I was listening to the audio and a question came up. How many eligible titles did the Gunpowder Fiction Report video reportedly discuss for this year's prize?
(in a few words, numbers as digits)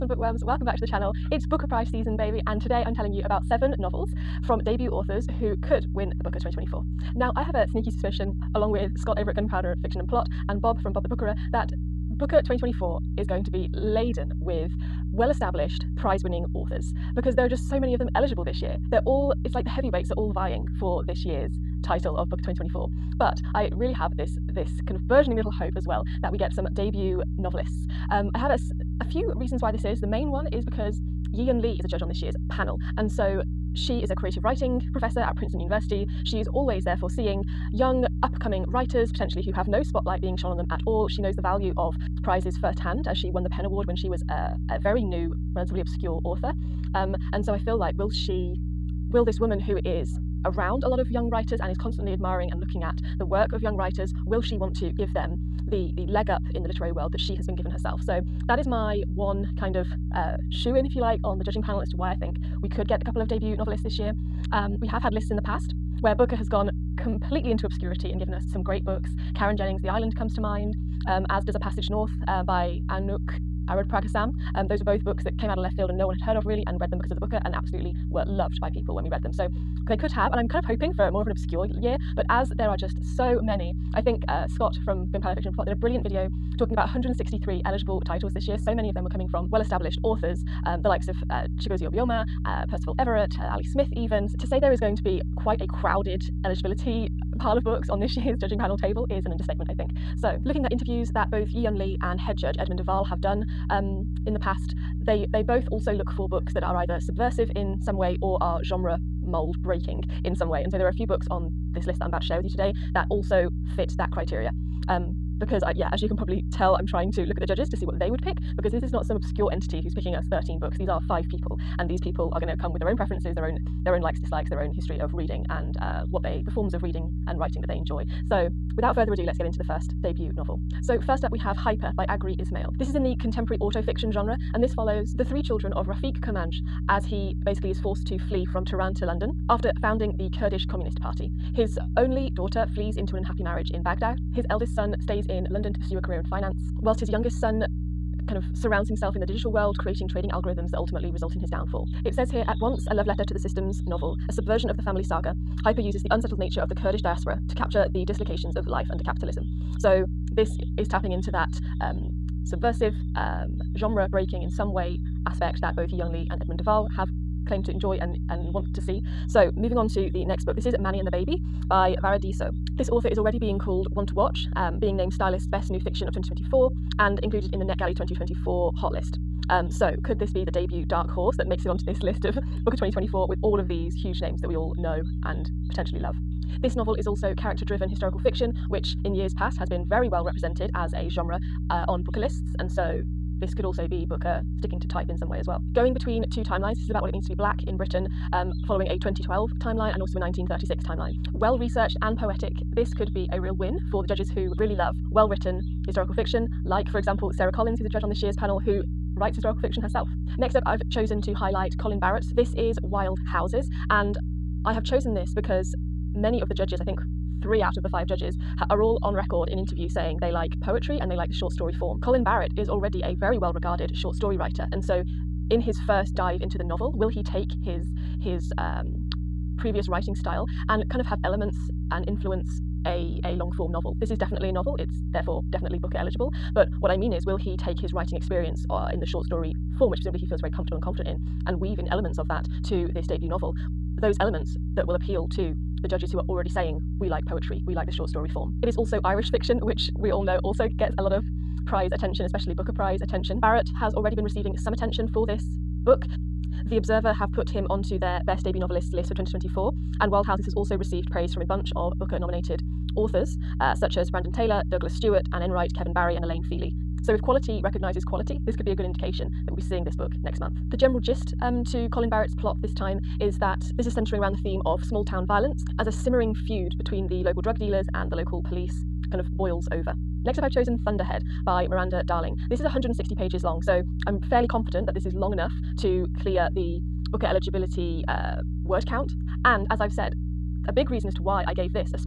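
163.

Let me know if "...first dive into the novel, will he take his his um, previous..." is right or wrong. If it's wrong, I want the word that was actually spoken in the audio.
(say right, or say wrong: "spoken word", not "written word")
right.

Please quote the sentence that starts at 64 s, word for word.
Um, we have had lists in the past where Booker has gone completely into obscurity and given us some great books.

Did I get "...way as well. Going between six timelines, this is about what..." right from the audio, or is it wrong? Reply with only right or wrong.
wrong.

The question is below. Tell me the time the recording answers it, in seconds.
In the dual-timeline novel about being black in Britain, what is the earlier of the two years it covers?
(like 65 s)
200 s.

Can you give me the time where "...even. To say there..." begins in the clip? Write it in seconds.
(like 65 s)
93 s.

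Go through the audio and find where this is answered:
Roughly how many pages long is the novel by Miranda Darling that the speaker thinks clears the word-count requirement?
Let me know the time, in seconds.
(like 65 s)
282 s.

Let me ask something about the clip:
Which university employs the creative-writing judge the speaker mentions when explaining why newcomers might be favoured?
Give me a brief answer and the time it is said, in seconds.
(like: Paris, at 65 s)
Princeton University, at 35 s.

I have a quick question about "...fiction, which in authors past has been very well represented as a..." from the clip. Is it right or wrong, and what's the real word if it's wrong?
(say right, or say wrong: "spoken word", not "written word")
wrong: "years", not "authors".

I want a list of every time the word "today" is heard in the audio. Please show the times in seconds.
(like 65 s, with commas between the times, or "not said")
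2 s, 112 s.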